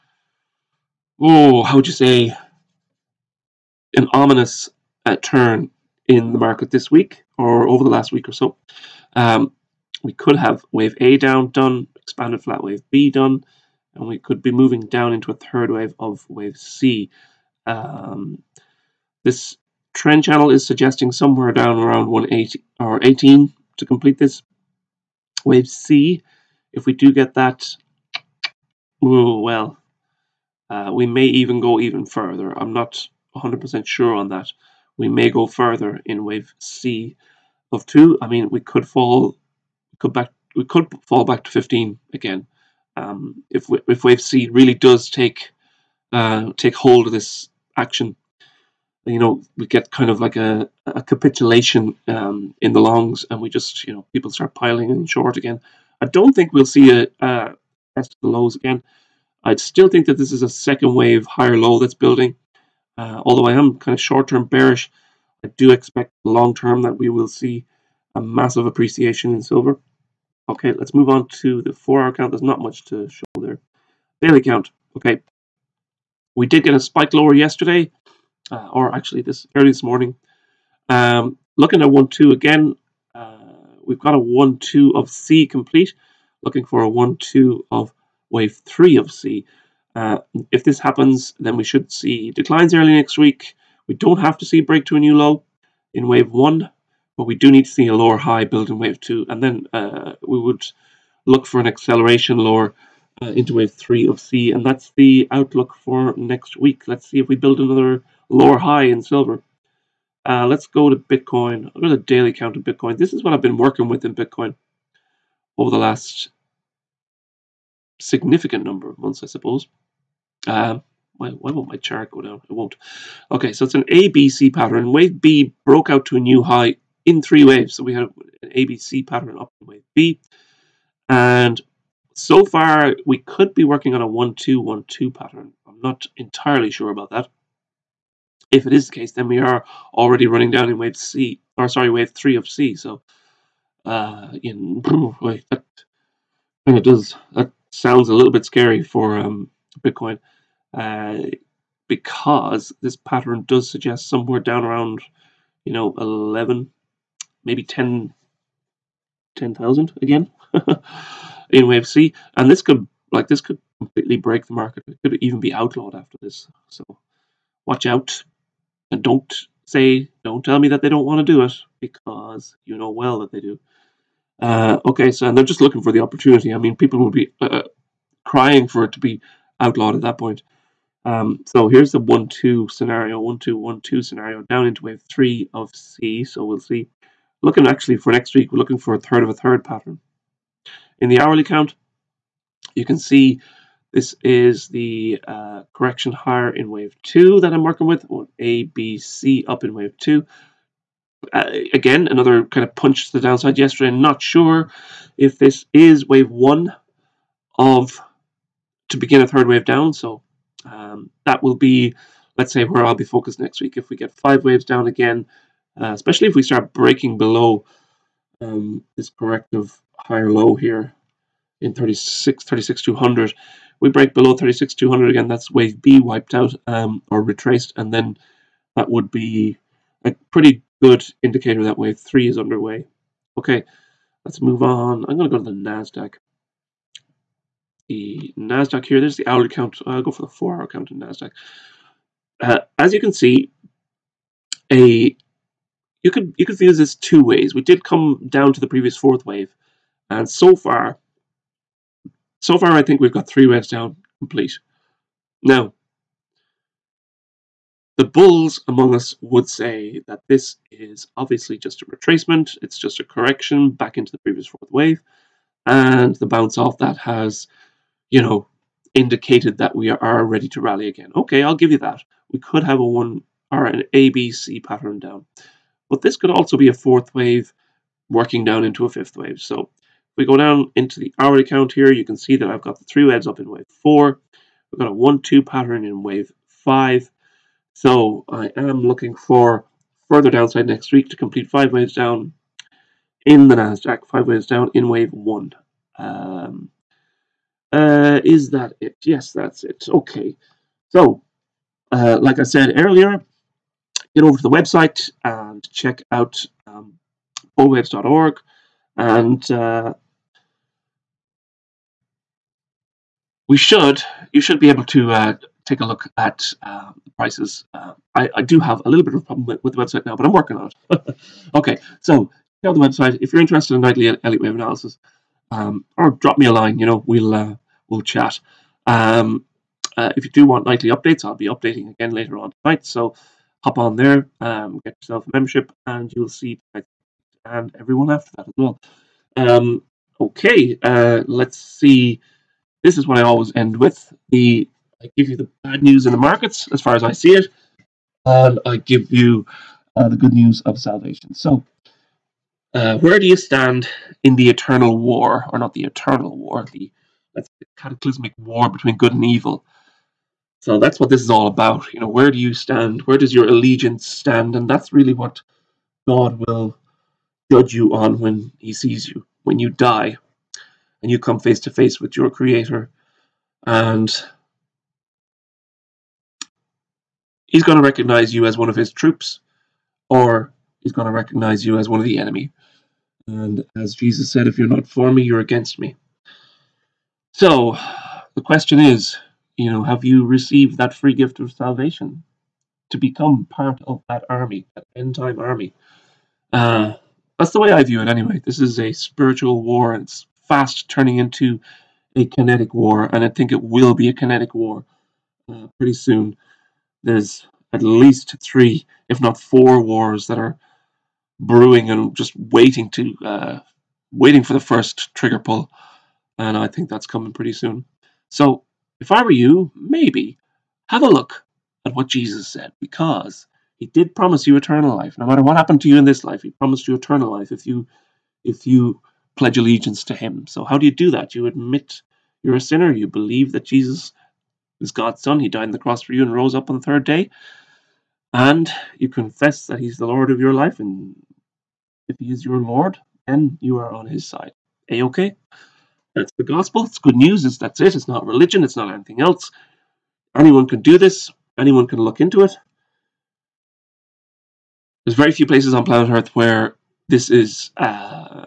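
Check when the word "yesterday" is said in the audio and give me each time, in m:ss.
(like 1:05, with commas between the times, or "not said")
1:17, 3:23.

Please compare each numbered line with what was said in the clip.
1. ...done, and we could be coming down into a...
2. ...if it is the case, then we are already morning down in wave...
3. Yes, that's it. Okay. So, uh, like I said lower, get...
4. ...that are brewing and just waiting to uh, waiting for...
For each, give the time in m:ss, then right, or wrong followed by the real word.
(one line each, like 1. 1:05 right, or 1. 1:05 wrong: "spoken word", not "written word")
1. 0:13 wrong: "moving", not "coming"
2. 2:18 wrong: "running", not "morning"
3. 4:59 wrong: "earlier", not "lower"
4. 6:50 right.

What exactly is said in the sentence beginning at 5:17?
Uh, I, I, do have a little bit of a problem with, with the website now, but I'm working on it.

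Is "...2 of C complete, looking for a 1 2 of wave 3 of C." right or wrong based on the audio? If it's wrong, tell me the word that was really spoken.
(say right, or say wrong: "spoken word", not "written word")
right.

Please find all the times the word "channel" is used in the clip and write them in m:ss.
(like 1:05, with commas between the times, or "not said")
0:20.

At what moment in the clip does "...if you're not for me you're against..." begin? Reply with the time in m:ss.
6:24.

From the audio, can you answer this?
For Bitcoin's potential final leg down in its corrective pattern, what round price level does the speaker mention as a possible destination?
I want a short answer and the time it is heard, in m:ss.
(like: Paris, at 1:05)
10,000, at 2:39.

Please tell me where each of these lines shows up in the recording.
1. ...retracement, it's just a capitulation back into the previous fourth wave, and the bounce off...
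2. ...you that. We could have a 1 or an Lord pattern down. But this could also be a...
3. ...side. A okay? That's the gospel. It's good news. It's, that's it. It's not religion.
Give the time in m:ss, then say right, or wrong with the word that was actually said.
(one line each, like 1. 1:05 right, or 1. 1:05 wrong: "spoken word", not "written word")
1. 4:21 wrong: "correction", not "capitulation"
2. 4:31 wrong: "ABC", not "Lord"
3. 7:24 right.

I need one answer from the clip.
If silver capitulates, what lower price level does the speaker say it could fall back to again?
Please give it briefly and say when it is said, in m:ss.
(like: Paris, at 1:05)
15, at 0:41.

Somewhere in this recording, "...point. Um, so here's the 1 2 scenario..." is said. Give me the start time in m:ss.
3:00.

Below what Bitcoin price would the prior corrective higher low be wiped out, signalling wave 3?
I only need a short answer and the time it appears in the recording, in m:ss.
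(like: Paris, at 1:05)
36,200, at 3:44.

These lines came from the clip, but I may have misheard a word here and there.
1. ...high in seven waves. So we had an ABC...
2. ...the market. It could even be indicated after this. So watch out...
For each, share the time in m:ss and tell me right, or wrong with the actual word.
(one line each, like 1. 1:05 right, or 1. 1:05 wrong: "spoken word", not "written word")
1. 2:06 wrong: "three", not "seven"
2. 2:44 wrong: "outlawed", not "indicated".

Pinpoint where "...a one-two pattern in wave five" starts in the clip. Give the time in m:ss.
4:44.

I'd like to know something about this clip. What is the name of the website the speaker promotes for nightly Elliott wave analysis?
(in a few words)
bullwaves.org.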